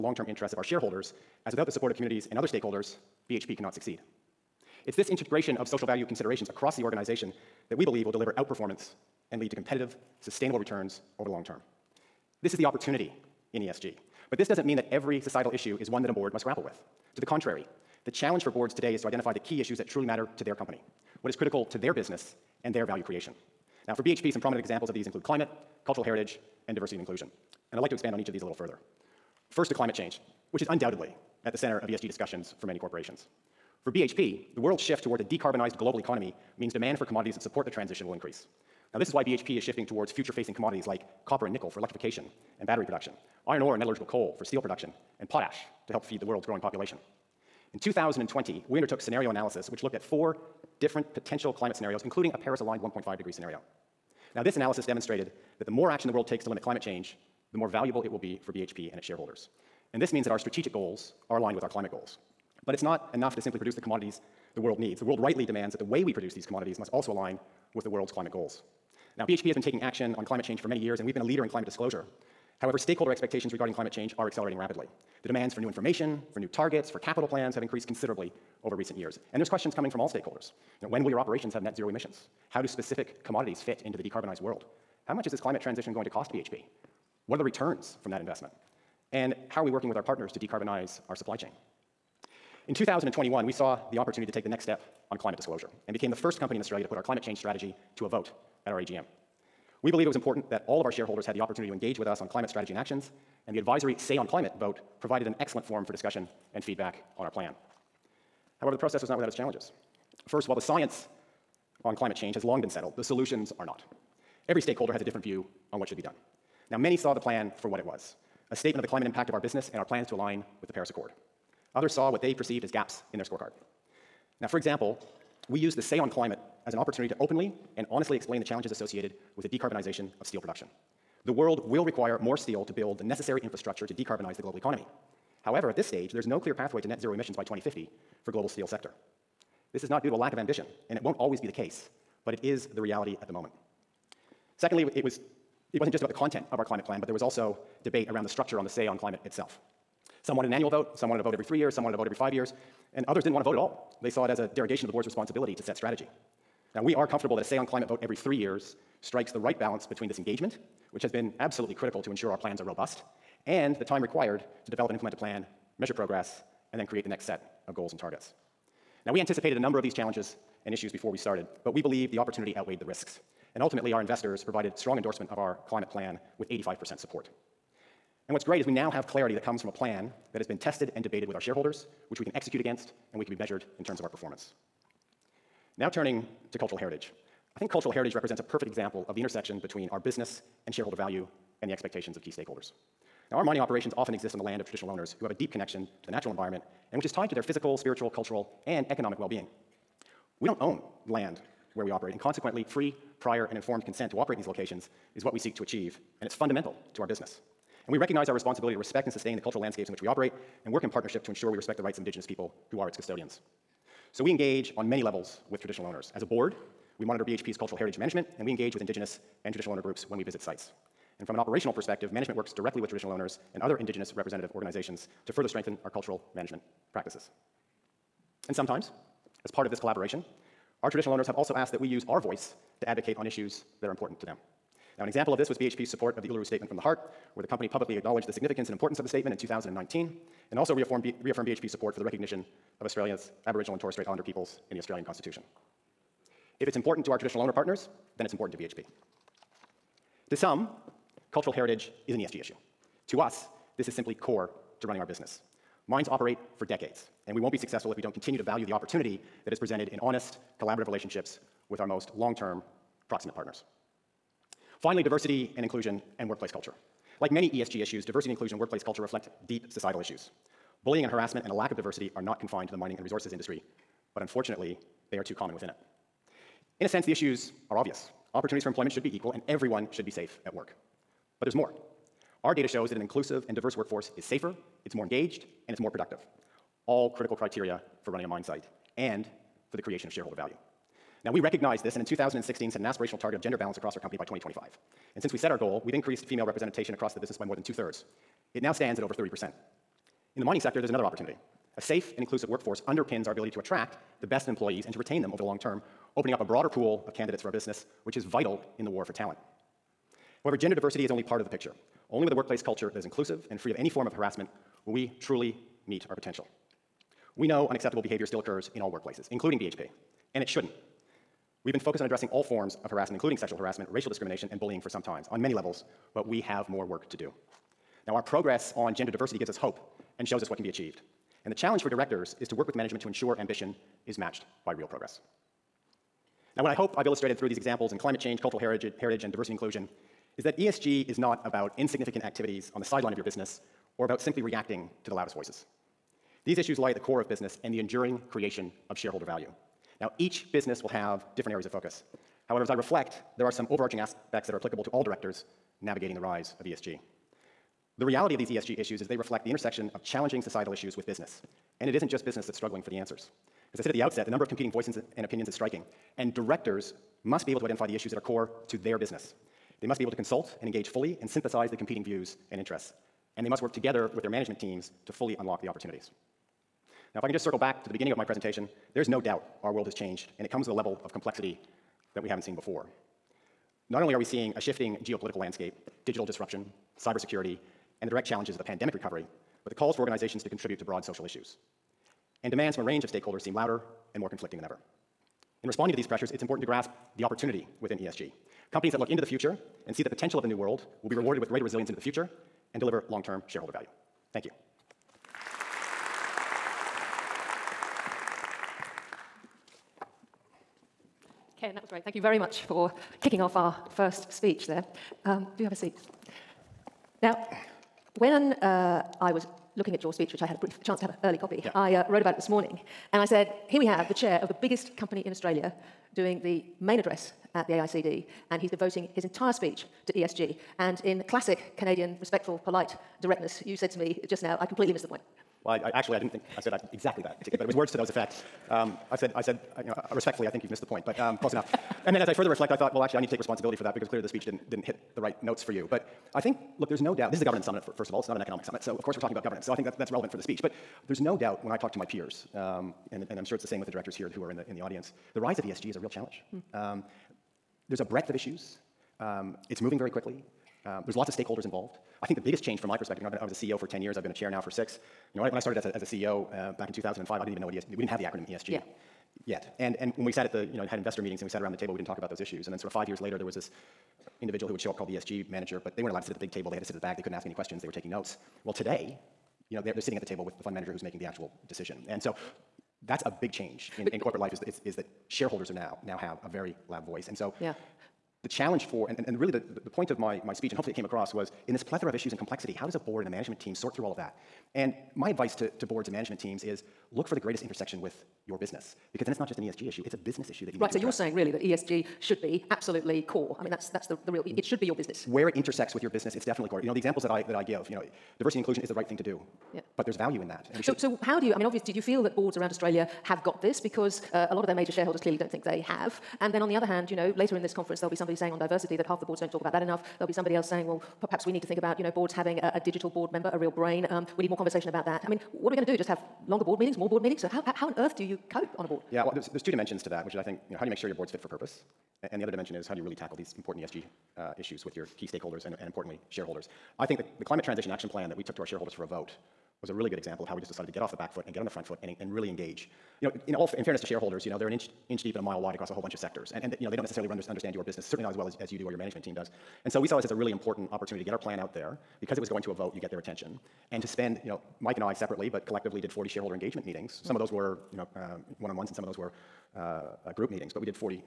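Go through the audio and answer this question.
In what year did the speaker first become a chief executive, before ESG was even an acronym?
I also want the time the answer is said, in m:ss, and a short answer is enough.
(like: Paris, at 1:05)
2005, at 7:46.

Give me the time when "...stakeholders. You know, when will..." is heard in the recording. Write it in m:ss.
1:20.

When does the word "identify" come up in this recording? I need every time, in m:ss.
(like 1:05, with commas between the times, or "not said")
0:19, 6:07.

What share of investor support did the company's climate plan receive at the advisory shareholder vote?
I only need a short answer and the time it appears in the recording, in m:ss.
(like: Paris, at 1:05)
85%, at 2:56.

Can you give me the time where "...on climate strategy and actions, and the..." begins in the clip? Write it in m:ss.
1:42.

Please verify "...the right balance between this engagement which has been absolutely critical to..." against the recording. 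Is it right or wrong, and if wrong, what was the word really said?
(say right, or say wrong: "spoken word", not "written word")
right.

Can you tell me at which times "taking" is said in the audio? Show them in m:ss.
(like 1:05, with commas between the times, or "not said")
1:09, 7:57.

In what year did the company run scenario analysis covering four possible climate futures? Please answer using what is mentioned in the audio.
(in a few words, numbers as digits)
2020.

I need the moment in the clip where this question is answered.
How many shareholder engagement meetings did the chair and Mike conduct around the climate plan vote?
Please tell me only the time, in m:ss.
9:16.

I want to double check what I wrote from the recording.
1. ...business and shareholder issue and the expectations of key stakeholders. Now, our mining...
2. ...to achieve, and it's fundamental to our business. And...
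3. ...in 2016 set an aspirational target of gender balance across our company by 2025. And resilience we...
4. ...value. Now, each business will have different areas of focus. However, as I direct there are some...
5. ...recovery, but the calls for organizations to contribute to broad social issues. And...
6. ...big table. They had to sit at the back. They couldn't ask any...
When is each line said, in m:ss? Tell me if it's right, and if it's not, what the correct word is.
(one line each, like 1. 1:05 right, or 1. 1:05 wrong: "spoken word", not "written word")
1. 3:09 wrong: "value", not "issue"
2. 3:25 right
3. 4:52 wrong: "since", not "resilience"
4. 5:49 wrong: "reflect", not "direct"
5. 6:28 right
6. 7:56 right.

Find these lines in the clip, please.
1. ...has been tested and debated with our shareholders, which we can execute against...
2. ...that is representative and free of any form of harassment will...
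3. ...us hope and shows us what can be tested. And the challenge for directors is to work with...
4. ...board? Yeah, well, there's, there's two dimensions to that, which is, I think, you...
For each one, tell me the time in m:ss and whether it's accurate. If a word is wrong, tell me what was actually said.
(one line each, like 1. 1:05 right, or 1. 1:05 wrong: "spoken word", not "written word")
1. 3:00 right
2. 5:12 wrong: "inclusive", not "representative"
3. 5:29 wrong: "achieved", not "tested"
4. 8:48 right.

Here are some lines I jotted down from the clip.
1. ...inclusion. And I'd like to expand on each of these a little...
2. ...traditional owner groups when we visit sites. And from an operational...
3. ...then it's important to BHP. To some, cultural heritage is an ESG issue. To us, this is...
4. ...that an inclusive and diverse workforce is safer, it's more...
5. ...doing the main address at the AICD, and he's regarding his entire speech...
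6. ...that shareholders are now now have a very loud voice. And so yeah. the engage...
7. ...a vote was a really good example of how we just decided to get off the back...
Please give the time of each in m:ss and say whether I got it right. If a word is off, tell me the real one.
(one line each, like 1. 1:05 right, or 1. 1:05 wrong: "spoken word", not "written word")
1. 0:26 right
2. 3:39 right
3. 4:08 right
4. 4:42 right
5. 7:06 wrong: "devoting", not "regarding"
6. 8:04 wrong: "challenge", not "engage"
7. 8:59 right.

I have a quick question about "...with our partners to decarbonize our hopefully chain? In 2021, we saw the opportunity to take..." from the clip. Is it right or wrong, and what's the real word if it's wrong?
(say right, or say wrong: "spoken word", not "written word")
wrong: "supply", not "hopefully".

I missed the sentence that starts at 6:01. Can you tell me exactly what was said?
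And it isn't just business that's struggling for the answers.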